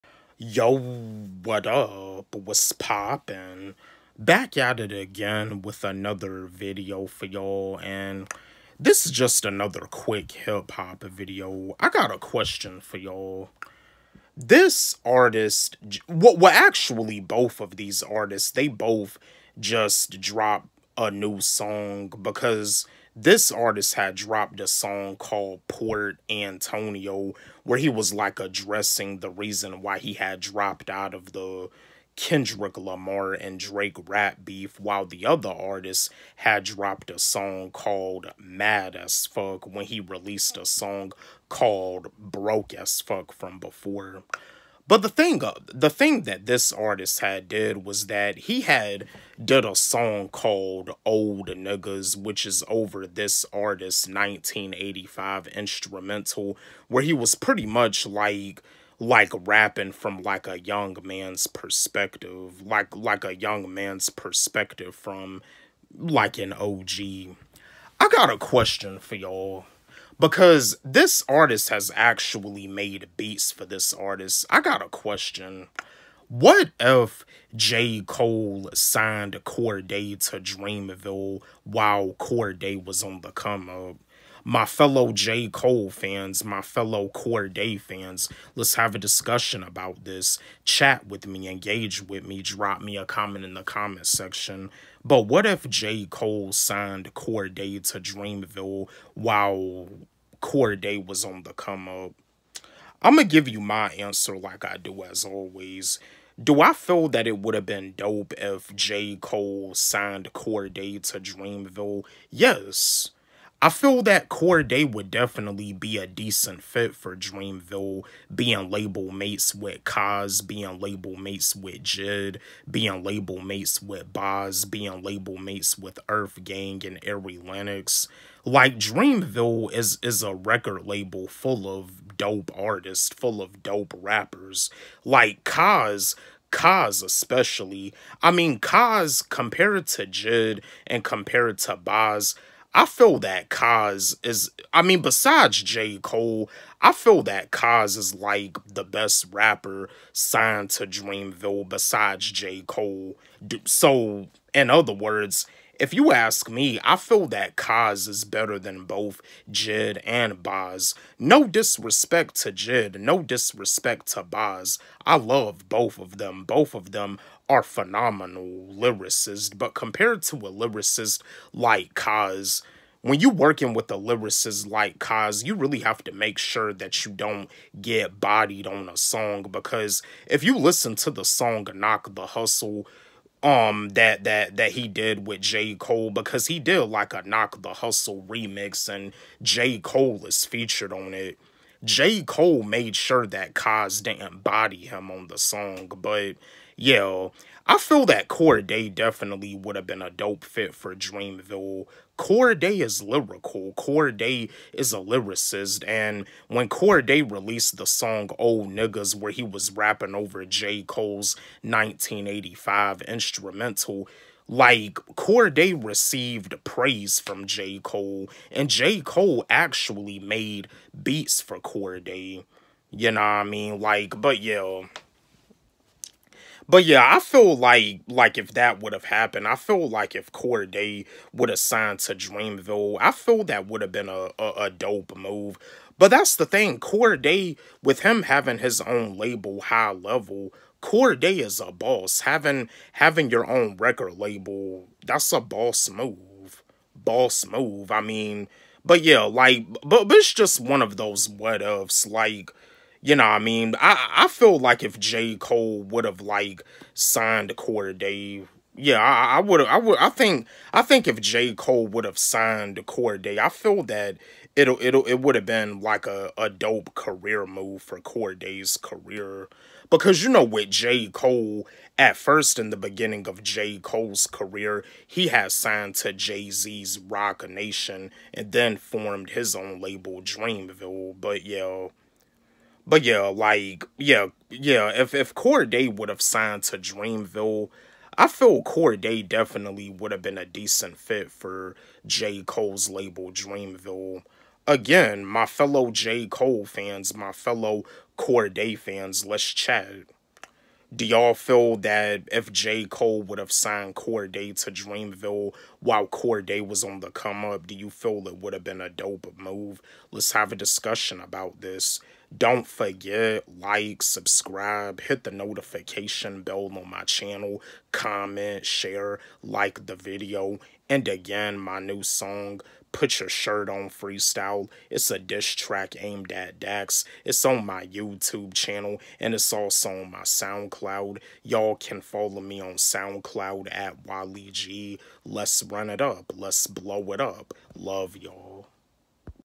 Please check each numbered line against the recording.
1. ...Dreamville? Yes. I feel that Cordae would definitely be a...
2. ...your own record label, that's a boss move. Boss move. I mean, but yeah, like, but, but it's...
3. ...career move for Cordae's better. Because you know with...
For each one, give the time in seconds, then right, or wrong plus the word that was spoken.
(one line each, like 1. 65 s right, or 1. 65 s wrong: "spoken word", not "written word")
1. 111 s right
2. 243 s right
3. 266 s wrong: "career", not "better".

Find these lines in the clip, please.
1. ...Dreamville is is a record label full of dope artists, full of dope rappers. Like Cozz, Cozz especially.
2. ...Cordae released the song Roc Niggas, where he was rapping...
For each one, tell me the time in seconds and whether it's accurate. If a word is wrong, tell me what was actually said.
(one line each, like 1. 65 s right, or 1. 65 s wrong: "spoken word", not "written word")
1. 128 s right
2. 206 s wrong: "Old", not "Roc".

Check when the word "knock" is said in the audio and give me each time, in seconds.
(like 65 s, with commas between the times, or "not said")
181 s, 187 s.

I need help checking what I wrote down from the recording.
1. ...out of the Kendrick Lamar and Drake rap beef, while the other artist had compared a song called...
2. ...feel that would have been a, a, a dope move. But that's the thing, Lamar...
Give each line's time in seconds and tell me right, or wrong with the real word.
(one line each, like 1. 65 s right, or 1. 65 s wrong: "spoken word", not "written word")
1. 30 s wrong: "dropped", not "compared"
2. 233 s wrong: "Cordae", not "Lamar".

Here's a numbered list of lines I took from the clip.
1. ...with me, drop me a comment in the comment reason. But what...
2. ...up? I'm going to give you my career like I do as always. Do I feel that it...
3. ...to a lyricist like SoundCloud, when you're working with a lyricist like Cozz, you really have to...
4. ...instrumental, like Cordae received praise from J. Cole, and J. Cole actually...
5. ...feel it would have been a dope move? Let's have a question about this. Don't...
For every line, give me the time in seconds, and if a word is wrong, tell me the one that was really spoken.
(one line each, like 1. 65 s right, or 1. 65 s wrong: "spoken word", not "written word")
1. 92 s wrong: "section", not "reason"
2. 101 s wrong: "answer", not "career"
3. 170 s wrong: "Cozz", not "SoundCloud"
4. 213 s right
5. 307 s wrong: "discussion", not "question".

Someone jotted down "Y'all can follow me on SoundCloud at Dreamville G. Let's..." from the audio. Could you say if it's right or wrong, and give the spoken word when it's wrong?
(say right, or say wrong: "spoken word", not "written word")
wrong: "Walle", not "Dreamville".